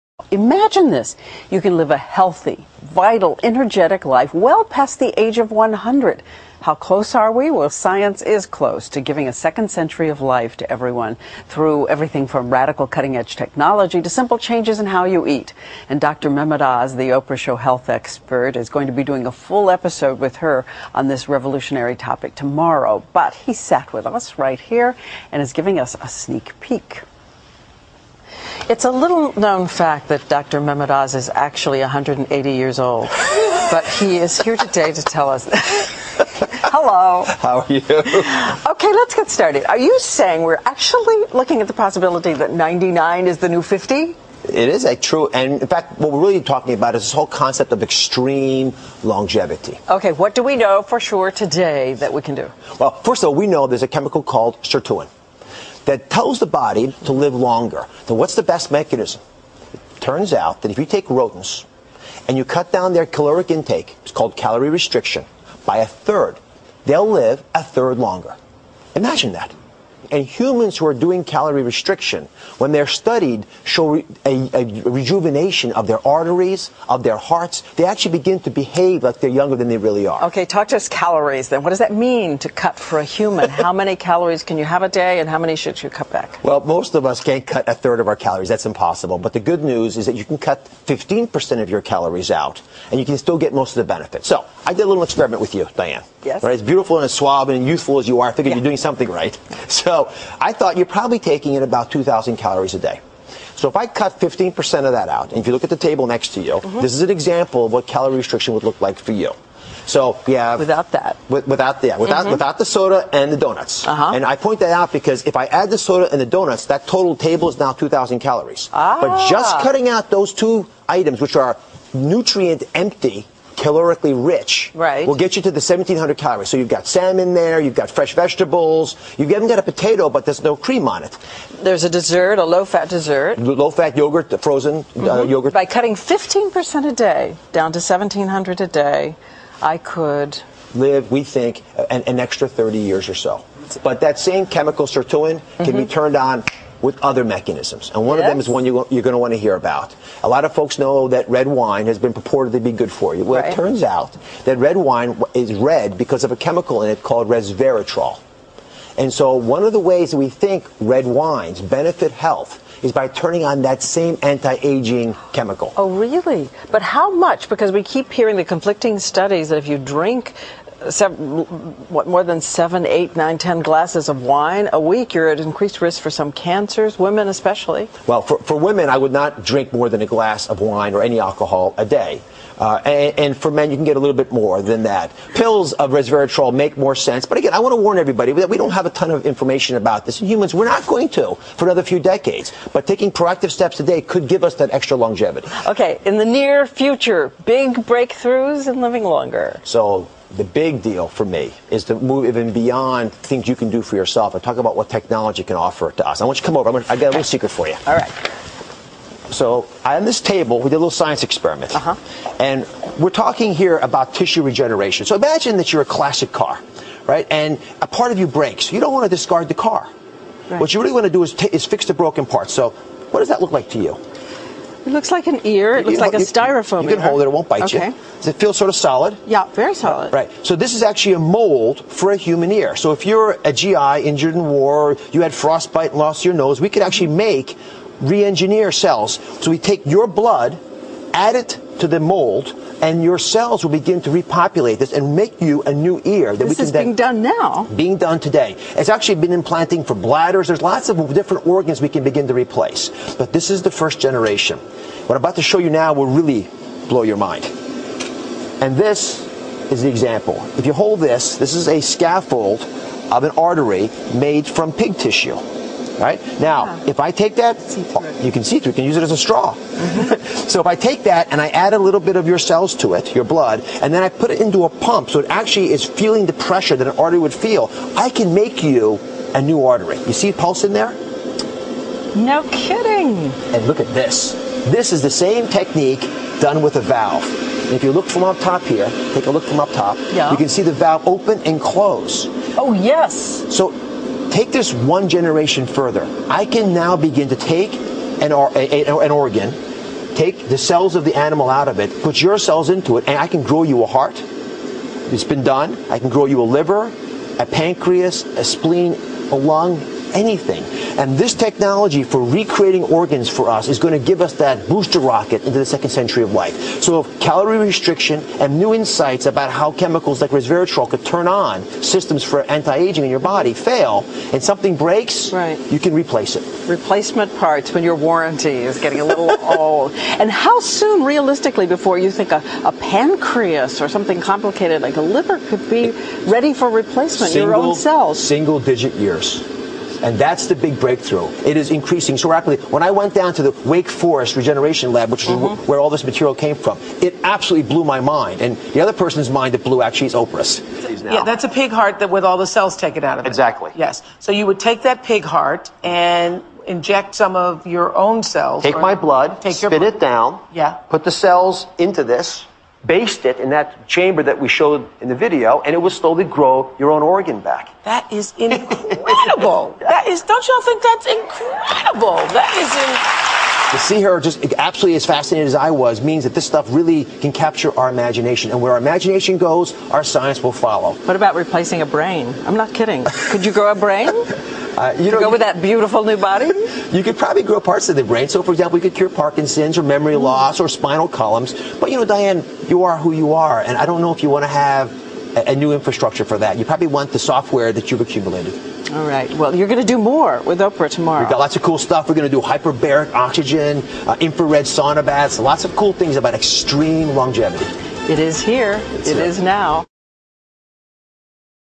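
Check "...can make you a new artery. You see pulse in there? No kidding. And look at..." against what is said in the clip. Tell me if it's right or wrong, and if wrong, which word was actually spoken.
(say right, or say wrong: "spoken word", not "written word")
right.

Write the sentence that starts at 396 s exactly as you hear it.
You probably want the software that you've accumulated.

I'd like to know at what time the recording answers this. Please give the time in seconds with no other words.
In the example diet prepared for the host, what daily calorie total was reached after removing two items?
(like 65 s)
125 s.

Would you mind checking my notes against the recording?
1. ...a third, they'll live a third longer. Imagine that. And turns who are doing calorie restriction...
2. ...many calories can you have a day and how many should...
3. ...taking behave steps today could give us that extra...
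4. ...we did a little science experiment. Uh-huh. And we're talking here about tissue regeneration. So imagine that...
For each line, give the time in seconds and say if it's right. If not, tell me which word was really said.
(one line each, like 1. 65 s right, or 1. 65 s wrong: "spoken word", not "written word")
1. 65 s wrong: "humans", not "turns"
2. 83 s right
3. 192 s wrong: "proactive", not "behave"
4. 210 s right.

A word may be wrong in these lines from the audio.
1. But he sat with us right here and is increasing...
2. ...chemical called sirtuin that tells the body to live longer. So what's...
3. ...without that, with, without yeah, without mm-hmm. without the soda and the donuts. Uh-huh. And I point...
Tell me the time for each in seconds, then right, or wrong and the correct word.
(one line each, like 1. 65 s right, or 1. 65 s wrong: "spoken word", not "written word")
1. 23 s wrong: "giving", not "increasing"
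2. 53 s right
3. 110 s right.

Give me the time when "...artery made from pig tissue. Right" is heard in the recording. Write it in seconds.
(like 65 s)
263 s.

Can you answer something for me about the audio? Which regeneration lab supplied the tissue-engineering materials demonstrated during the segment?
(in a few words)
Wake Forest Regeneration Lab.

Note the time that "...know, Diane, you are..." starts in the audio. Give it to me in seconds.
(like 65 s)
391 s.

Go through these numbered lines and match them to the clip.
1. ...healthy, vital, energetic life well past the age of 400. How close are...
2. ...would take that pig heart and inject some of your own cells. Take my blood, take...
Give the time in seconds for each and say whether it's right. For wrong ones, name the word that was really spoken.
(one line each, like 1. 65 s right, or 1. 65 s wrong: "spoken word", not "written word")
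1. 1 s wrong: "100", not "400"
2. 354 s right.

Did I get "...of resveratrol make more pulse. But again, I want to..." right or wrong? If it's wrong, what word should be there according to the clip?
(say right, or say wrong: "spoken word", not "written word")
wrong: "sense", not "pulse".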